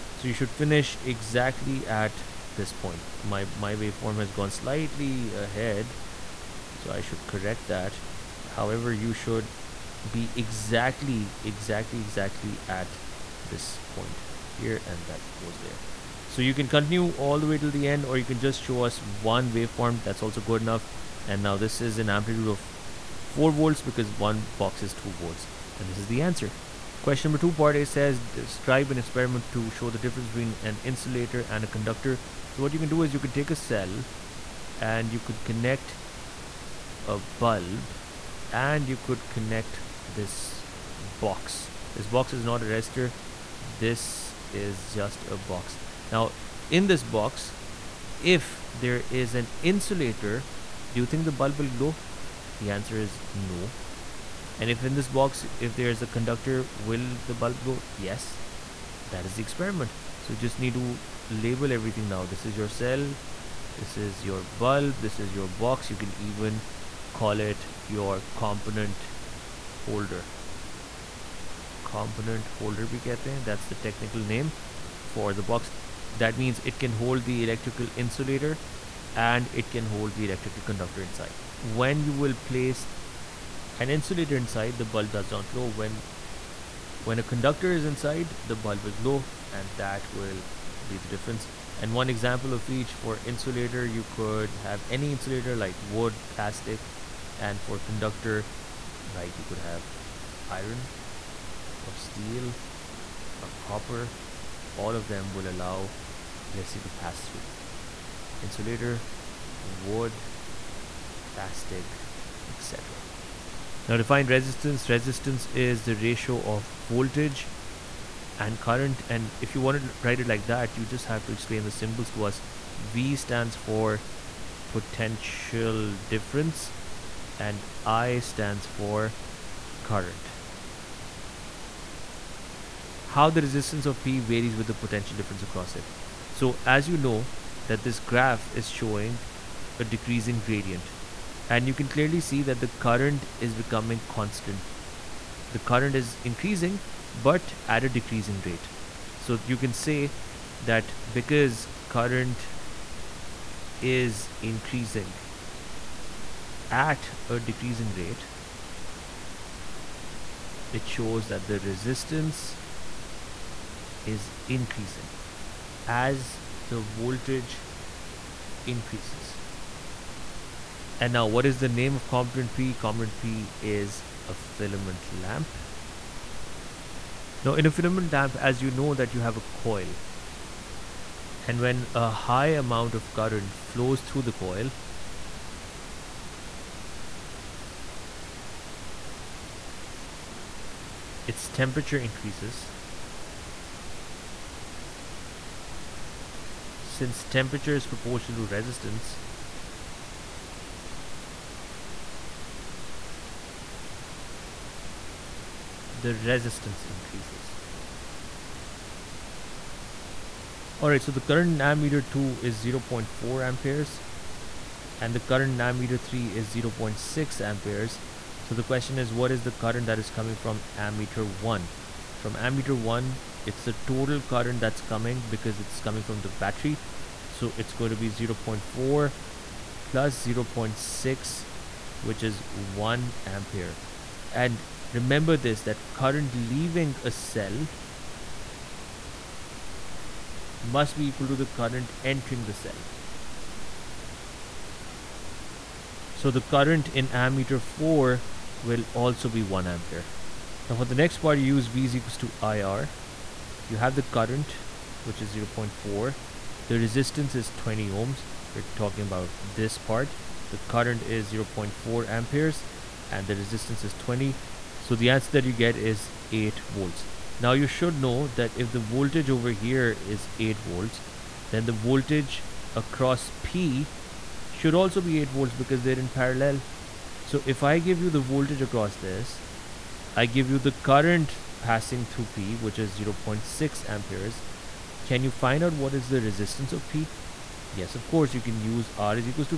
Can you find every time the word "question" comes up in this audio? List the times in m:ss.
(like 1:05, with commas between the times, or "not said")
0:27, 3:38.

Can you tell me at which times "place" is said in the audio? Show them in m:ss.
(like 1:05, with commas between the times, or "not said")
1:22.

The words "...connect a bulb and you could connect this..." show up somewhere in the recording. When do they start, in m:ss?
0:35.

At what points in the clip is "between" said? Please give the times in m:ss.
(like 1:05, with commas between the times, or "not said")
0:30.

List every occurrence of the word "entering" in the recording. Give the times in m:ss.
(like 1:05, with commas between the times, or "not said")
4:02.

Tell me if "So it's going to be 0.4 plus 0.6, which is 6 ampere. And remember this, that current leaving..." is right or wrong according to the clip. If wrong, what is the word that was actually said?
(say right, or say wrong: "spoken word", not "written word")
wrong: "1", not "6".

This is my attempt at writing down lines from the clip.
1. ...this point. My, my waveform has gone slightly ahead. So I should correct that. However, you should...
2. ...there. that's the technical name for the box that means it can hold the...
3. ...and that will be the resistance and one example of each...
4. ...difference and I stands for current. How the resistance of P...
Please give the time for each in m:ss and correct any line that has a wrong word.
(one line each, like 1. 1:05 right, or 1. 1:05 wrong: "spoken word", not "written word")
1. 0:02 right
2. 1:13 right
3. 1:29 wrong: "difference", not "resistance"
4. 2:05 right.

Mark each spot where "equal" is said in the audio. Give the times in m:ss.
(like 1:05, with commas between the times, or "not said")
4:01, 4:11.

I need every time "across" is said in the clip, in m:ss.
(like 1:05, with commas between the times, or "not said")
2:15, 4:32, 4:38.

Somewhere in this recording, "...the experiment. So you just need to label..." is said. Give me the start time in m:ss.
0:59.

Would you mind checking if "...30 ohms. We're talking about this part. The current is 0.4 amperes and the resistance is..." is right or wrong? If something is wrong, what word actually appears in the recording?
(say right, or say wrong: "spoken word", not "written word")
wrong: "20", not "30".